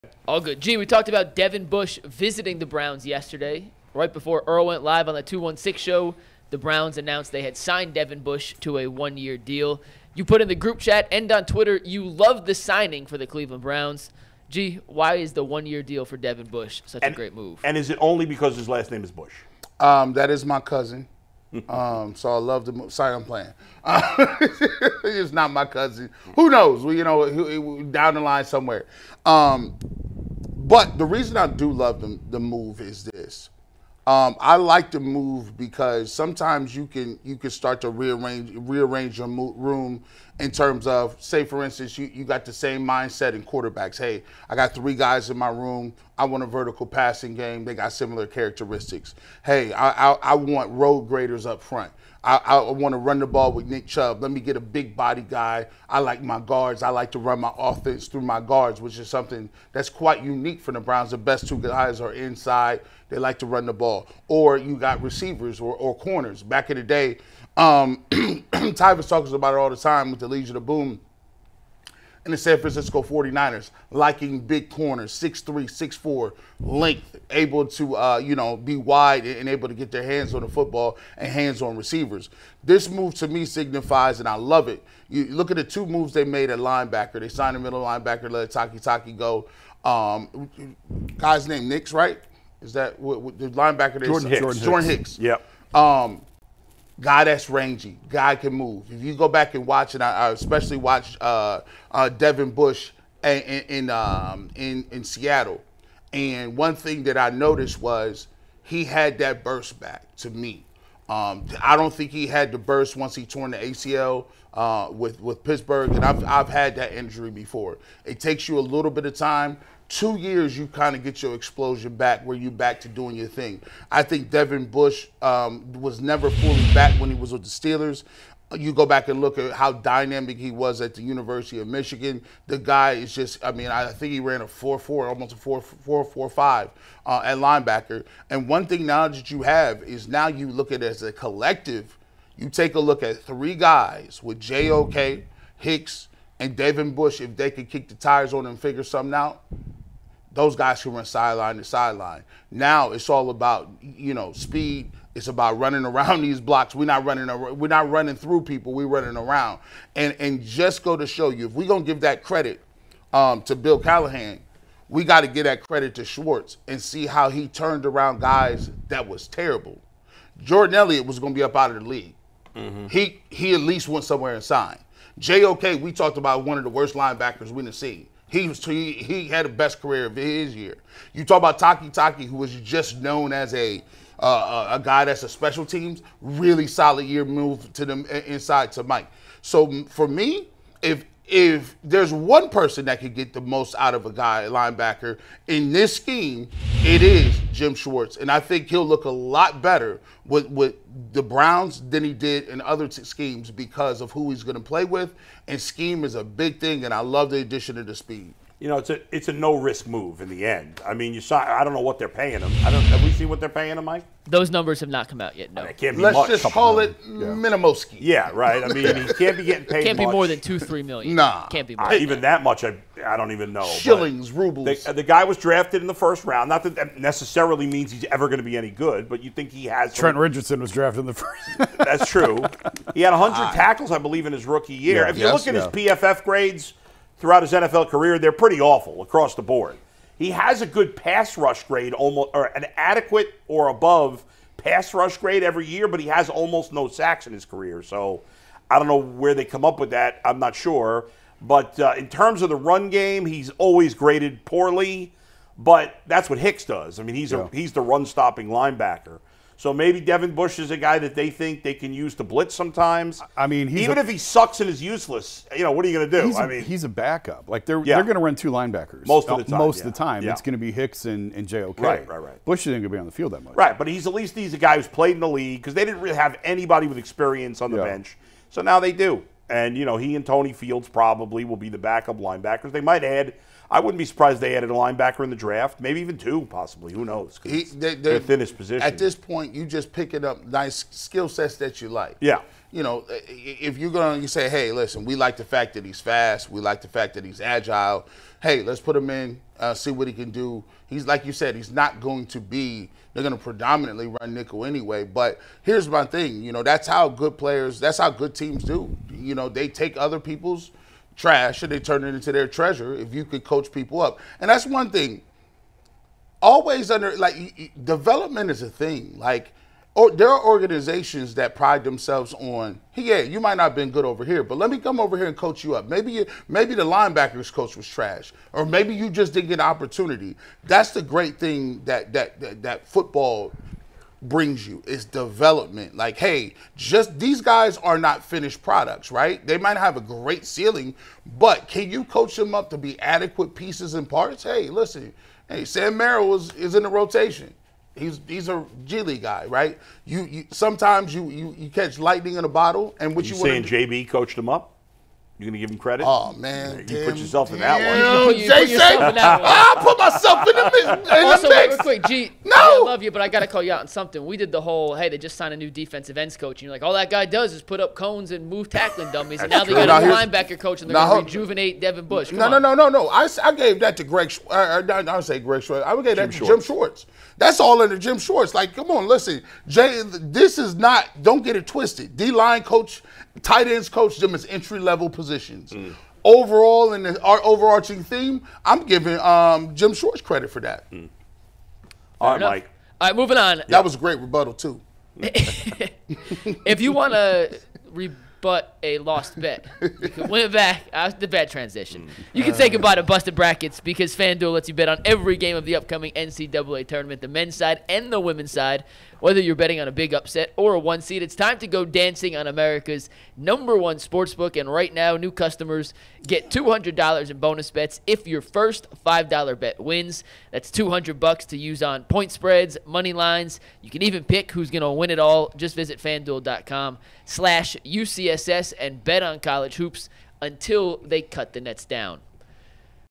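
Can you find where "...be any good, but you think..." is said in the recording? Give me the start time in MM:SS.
03:48.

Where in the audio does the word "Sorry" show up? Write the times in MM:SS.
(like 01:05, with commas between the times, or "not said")
00:22.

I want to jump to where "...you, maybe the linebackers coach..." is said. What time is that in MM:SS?
05:26.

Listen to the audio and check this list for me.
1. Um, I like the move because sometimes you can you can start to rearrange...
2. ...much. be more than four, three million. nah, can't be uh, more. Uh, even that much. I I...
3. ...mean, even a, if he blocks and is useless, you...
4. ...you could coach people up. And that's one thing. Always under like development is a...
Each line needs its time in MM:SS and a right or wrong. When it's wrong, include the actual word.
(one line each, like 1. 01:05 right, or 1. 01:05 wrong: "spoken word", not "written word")
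1. 00:34 right
2. 03:39 wrong: "two", not "four"
3. 04:23 wrong: "sucks", not "blocks"
4. 05:13 right.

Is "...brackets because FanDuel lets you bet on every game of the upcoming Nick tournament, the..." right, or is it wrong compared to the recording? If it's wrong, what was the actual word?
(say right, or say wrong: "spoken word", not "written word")
wrong: "NCAA", not "Nick".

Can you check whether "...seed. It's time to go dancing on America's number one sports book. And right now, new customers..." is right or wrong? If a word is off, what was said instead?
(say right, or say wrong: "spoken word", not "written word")
right.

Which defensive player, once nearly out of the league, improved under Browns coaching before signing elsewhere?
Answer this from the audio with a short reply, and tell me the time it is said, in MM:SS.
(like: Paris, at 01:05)
Jordan Elliott, at 02:50.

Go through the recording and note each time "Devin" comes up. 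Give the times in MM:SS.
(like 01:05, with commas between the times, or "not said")
00:01, 00:07, 00:16, 01:42, 02:04, 02:26, 04:20, 06:11.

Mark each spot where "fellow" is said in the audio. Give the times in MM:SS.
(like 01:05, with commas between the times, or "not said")
not said.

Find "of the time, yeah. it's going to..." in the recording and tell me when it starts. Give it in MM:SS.
04:29.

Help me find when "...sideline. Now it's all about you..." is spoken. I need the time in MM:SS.
02:31.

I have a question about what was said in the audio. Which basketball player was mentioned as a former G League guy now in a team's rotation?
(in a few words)
Sam Merrill.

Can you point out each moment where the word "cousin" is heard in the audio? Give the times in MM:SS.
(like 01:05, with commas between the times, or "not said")
00:20, 00:25.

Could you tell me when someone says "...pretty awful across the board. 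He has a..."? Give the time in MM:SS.
03:58.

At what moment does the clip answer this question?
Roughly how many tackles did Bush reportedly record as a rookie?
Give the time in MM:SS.
03:53.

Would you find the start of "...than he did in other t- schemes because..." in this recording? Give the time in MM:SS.
03:21.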